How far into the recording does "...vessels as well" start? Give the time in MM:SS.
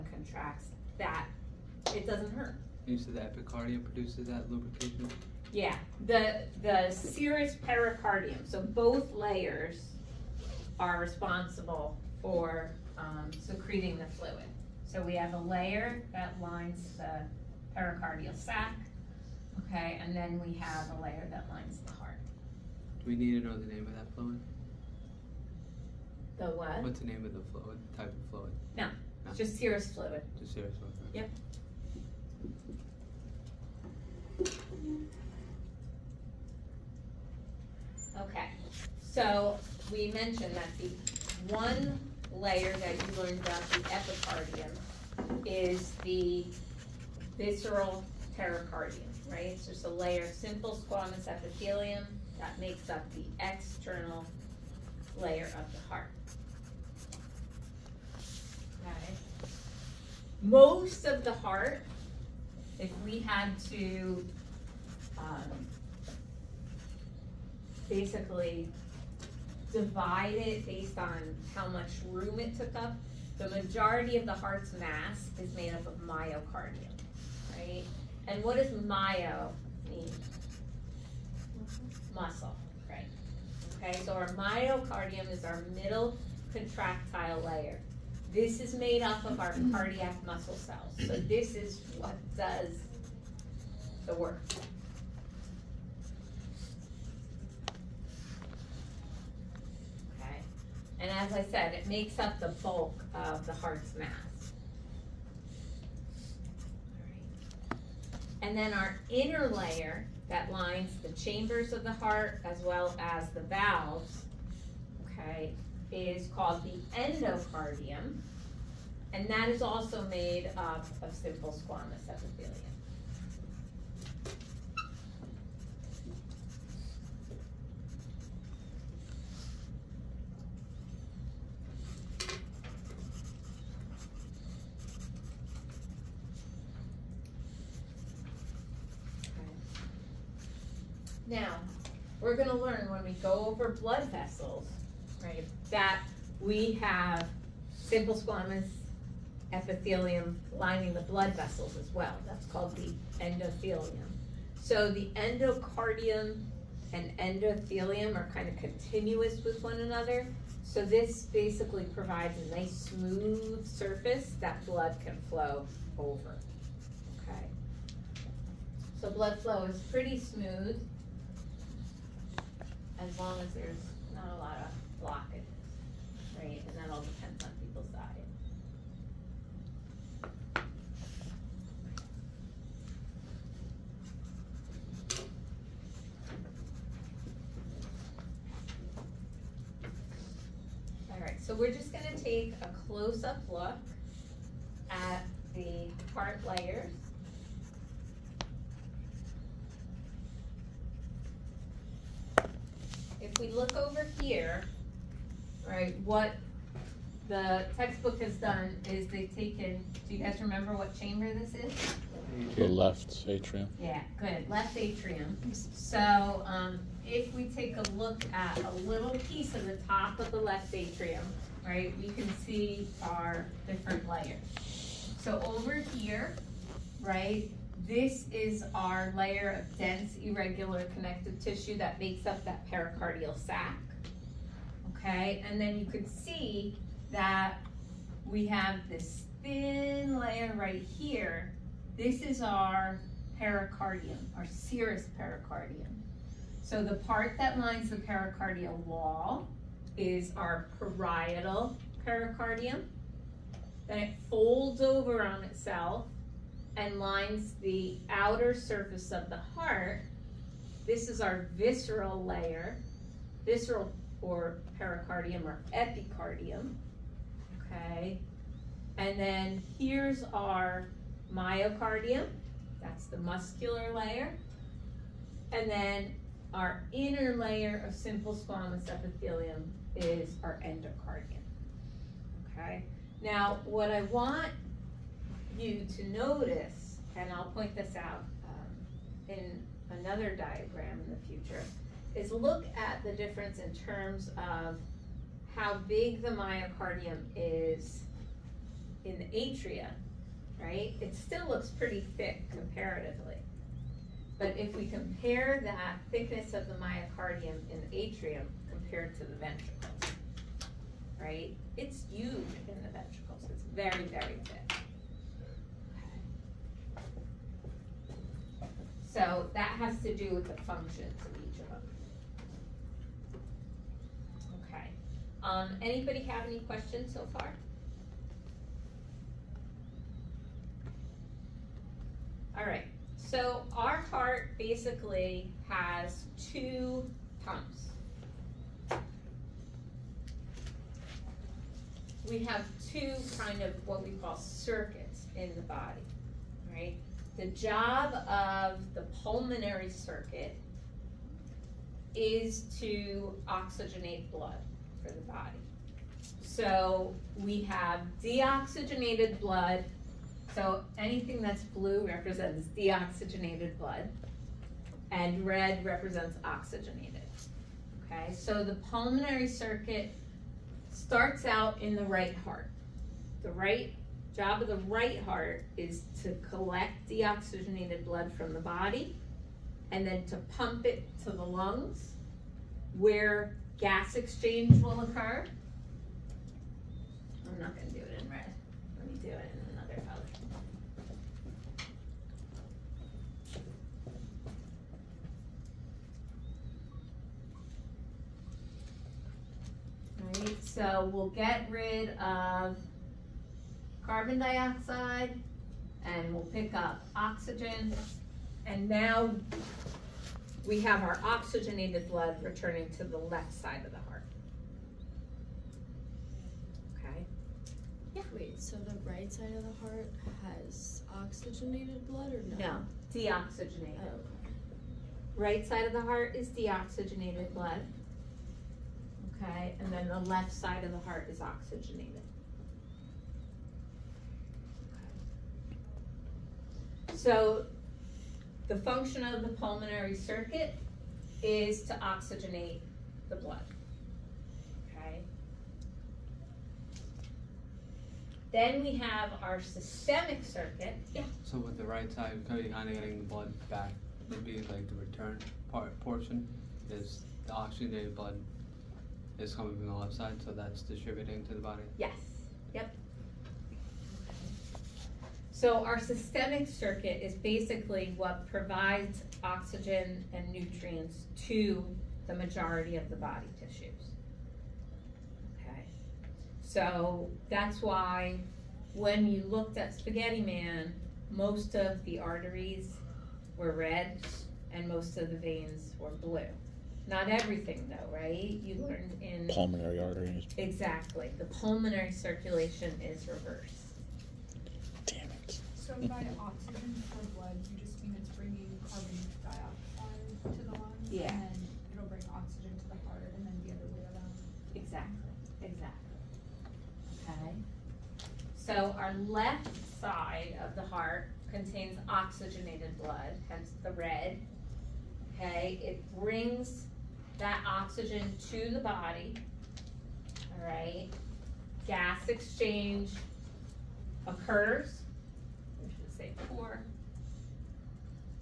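02:31.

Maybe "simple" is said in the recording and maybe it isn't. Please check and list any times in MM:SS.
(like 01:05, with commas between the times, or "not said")
00:50, 02:01, 02:27, 04:37.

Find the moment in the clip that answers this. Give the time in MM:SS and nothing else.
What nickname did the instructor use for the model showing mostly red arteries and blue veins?
07:59.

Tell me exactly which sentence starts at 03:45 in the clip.
So over here, right, this is our layer of dense, irregular connective tissue that makes up that pericardial sac.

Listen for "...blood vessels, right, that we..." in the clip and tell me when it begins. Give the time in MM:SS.
02:23.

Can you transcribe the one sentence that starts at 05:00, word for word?
It still looks pretty thick comparatively.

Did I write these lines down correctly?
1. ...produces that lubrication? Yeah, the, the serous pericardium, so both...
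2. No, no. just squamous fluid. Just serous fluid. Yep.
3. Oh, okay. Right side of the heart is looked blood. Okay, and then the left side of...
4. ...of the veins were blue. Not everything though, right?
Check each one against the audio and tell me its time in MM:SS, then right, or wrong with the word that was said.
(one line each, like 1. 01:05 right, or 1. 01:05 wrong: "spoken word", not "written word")
1. 00:03 right
2. 00:28 wrong: "serous", not "squamous"
3. 07:04 wrong: "deoxygenated", not "looked"
4. 08:05 right.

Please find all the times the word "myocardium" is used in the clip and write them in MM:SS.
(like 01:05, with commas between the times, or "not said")
01:15, 01:24, 04:31, 04:56, 05:06.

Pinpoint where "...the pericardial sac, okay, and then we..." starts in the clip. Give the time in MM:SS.
00:16.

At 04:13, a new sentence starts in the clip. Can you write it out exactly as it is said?
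Then it folds over on itself and lines the outer surface of the heart.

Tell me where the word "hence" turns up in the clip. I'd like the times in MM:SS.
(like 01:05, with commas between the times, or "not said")
08:33.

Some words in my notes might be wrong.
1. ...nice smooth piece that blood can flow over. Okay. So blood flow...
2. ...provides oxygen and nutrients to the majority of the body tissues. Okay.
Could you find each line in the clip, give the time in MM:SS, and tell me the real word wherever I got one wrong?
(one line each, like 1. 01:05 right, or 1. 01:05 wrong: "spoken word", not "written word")
1. 02:42 wrong: "surface", not "piece"
2. 07:48 right.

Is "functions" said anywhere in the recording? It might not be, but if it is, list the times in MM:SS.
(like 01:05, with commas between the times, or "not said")
05:20, 07:18.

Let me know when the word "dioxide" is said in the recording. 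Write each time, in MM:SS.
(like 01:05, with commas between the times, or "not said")
06:44, 08:19.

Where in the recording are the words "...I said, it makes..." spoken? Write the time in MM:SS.
01:41.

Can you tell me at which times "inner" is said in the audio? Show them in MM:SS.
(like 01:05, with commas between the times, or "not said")
01:49, 04:36.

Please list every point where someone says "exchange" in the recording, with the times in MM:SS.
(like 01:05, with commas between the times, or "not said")
06:24, 08:42.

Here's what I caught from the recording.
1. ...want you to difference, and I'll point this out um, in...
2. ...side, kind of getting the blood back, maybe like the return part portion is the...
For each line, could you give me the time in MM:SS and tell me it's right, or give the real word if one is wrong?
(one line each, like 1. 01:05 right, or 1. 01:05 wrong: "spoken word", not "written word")
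1. 04:44 wrong: "notice", not "difference"
2. 07:32 right.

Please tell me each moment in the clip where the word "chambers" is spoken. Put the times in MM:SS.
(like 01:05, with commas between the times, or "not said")
01:51, 03:30.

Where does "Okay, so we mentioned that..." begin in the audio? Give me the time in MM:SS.
00:38.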